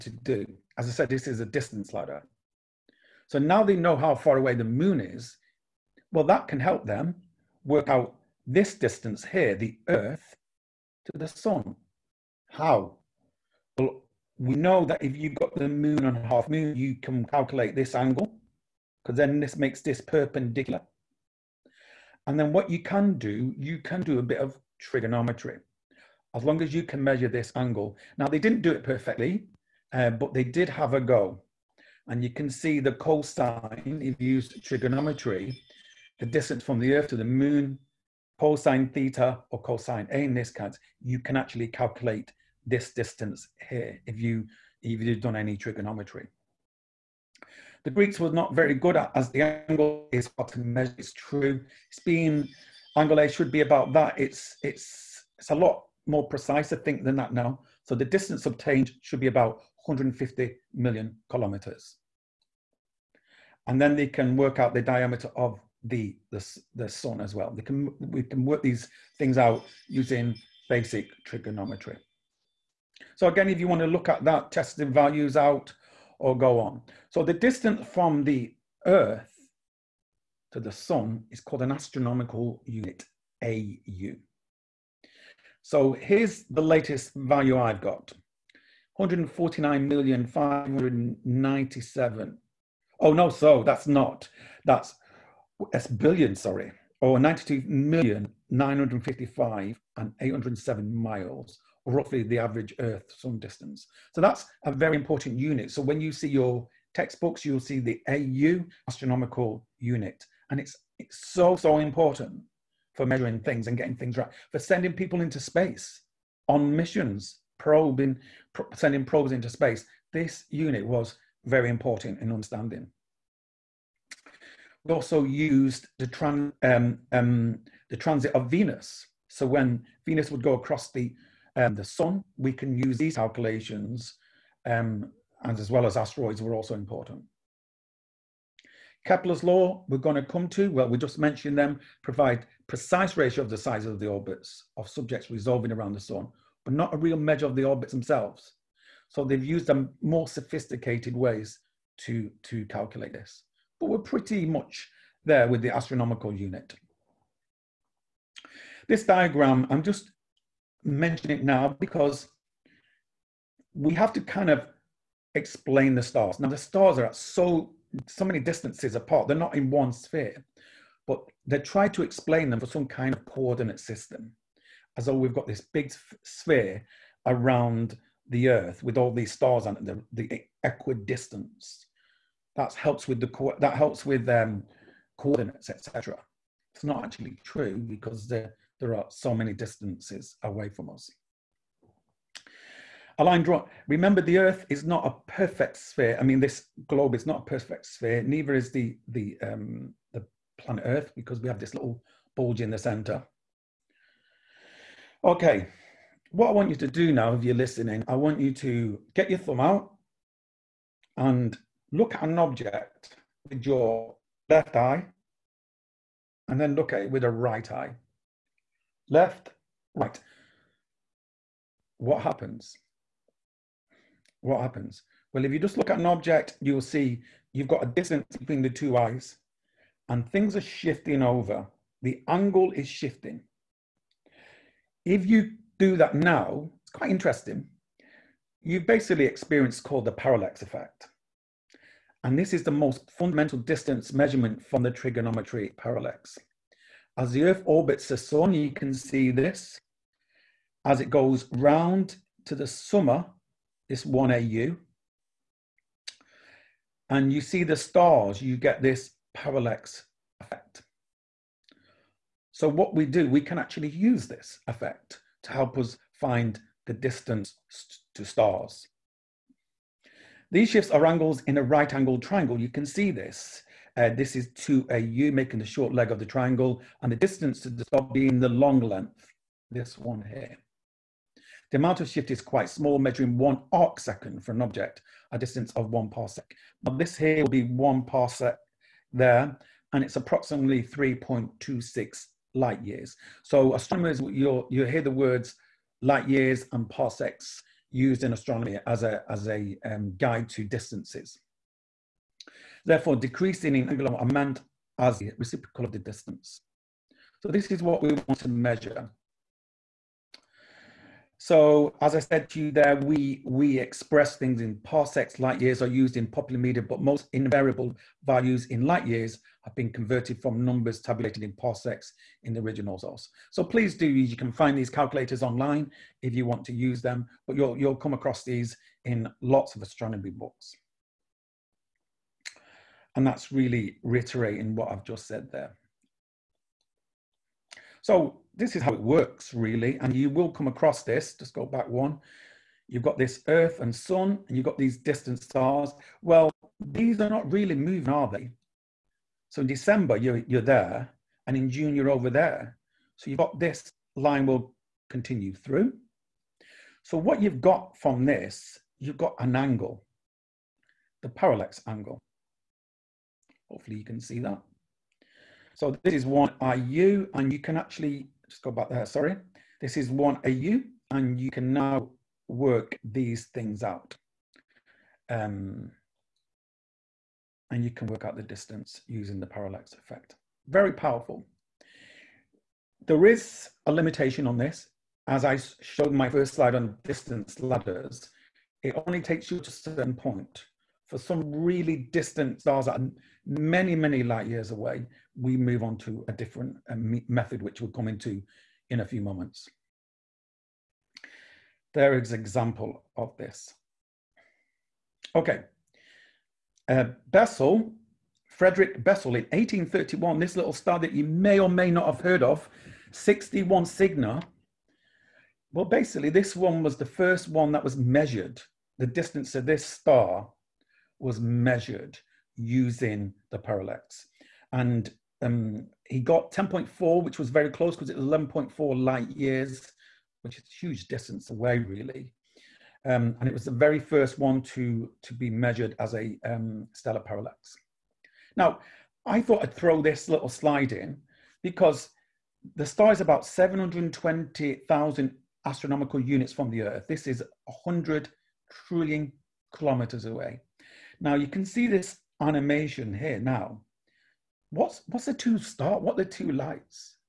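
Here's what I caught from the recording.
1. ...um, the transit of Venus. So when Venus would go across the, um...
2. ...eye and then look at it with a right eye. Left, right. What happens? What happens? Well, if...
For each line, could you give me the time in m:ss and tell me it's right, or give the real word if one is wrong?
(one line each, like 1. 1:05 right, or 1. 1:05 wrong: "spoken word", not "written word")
1. 2:07 right
2. 3:34 right.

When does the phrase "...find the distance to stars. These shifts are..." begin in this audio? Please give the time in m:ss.
4:26.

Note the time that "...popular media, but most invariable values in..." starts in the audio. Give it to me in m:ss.
5:16.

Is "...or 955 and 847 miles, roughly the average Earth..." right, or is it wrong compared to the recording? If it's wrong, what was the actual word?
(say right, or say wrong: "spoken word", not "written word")
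wrong: "807", not "847".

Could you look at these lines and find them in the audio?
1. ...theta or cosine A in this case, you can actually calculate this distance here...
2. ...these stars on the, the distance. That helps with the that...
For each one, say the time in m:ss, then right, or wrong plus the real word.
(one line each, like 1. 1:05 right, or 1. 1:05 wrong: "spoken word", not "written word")
1. 0:38 right
2. 2:59 wrong: "equidistance", not "distance".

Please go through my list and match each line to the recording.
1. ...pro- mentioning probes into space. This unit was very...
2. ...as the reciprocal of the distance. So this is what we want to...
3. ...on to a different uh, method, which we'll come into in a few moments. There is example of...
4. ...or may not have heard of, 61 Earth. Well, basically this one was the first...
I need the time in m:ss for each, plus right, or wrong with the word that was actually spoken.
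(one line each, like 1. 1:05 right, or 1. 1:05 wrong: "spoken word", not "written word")
1. 1:58 wrong: "sending", not "mentioning"
2. 5:04 right
3. 6:35 right
4. 6:51 wrong: "Cygni", not "Earth".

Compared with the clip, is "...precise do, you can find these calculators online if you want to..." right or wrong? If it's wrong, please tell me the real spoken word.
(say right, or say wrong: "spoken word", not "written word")
wrong: "please", not "precise".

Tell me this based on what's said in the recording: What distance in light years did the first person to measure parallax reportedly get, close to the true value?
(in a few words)
10.4.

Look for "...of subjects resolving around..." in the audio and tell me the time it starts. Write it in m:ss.
2:24.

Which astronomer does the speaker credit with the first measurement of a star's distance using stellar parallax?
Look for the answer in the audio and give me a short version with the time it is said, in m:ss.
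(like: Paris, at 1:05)
Frederick Bessel, at 6:48.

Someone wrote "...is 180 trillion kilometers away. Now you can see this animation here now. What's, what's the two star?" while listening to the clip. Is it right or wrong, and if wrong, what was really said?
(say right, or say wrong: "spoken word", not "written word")
wrong: "100", not "180".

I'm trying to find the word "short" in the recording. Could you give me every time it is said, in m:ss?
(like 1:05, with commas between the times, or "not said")
4:35.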